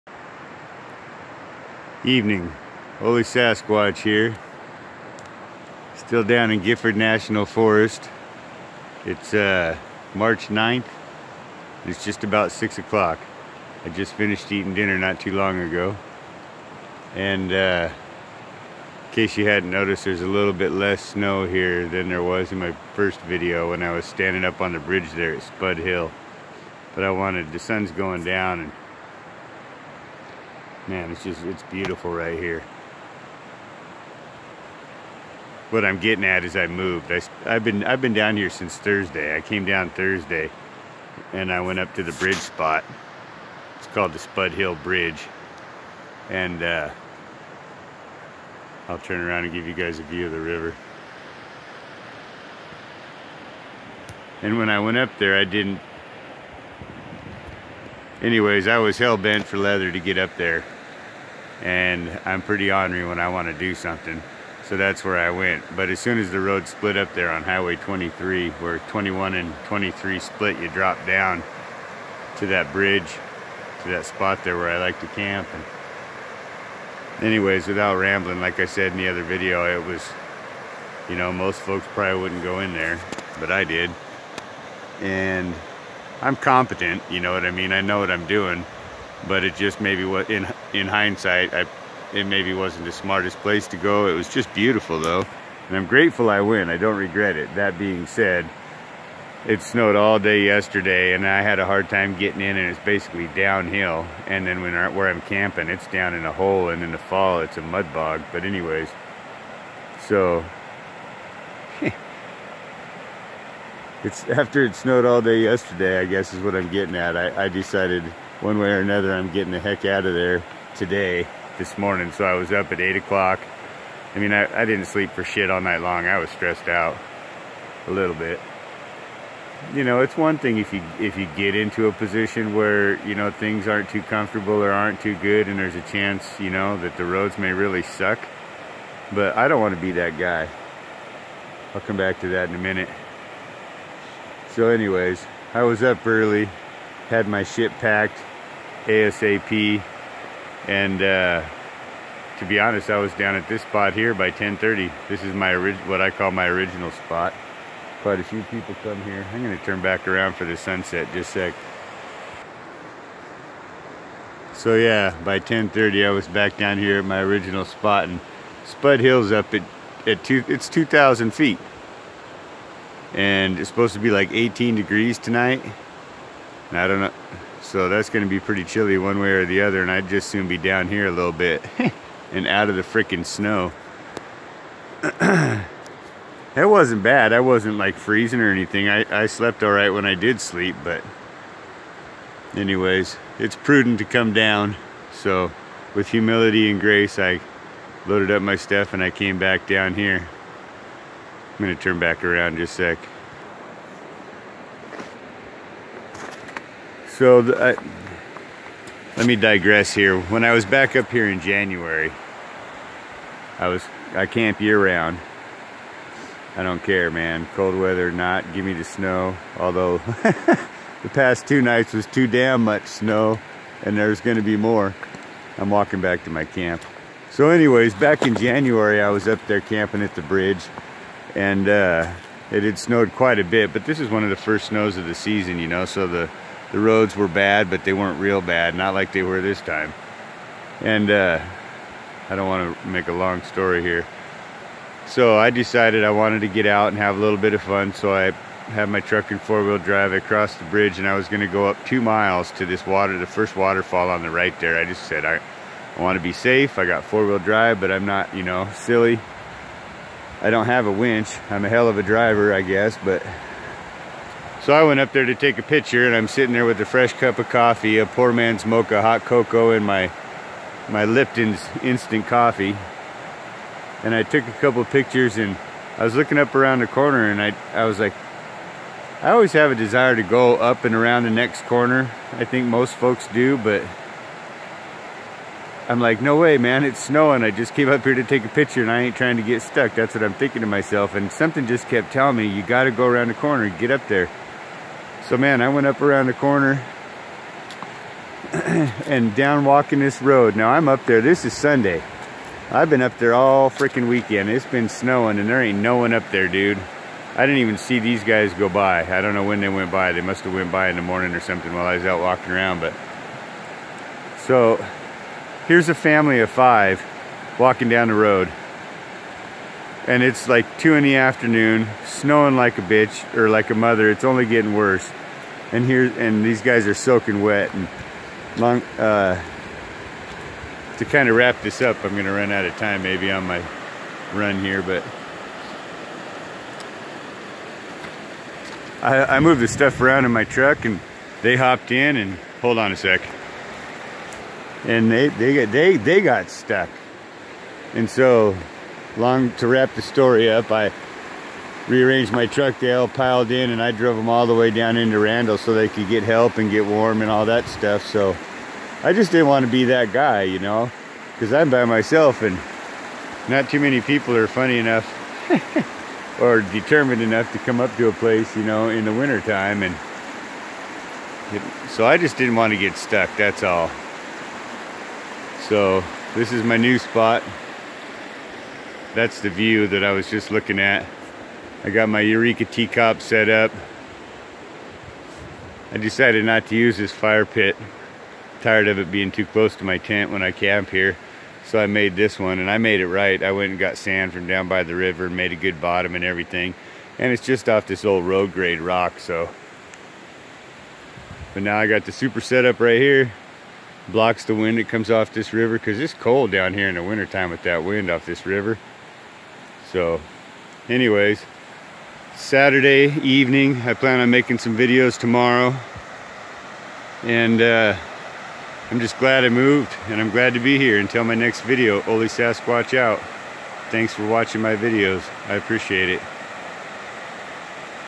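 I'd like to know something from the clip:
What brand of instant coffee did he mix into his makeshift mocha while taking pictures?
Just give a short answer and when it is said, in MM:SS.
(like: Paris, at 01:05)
Lipton's, at 04:31.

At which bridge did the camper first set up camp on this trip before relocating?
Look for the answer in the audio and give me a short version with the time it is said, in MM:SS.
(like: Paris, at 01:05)
Spud Hill Bridge, at 00:44.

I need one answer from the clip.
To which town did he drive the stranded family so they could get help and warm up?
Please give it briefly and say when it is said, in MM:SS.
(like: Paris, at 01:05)
Randle, at 05:55.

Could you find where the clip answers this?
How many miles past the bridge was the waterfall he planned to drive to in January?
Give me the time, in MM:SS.
04:11.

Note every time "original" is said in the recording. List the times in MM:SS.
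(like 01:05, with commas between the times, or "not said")
02:36, 02:47.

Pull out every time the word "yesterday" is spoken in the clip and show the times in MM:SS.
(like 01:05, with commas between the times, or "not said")
01:40, 01:55.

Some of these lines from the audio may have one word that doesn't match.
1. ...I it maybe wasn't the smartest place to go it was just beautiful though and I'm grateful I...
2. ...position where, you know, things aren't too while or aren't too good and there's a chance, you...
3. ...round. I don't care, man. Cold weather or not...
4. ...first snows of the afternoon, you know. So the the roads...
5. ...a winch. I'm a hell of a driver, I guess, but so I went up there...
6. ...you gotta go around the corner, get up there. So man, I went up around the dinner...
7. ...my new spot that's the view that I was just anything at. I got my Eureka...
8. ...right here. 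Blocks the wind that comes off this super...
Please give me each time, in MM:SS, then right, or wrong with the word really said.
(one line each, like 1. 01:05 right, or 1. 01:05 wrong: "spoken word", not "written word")
1. 01:31 right
2. 02:11 wrong: "comfortable", not "while"
3. 03:34 right
4. 03:54 wrong: "season", not "afternoon"
5. 04:20 right
6. 04:52 wrong: "corner", not "dinner"
7. 06:16 wrong: "looking", not "anything"
8. 06:42 wrong: "river", not "super".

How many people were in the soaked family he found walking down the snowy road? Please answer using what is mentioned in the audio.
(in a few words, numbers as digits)
5.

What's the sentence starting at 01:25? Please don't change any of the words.
And I'm competent, you know what I mean?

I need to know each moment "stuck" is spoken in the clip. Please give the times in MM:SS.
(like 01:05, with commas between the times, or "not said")
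04:49, 05:46, 06:12.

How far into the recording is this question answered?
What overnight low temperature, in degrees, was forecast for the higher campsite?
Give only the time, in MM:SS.
02:54.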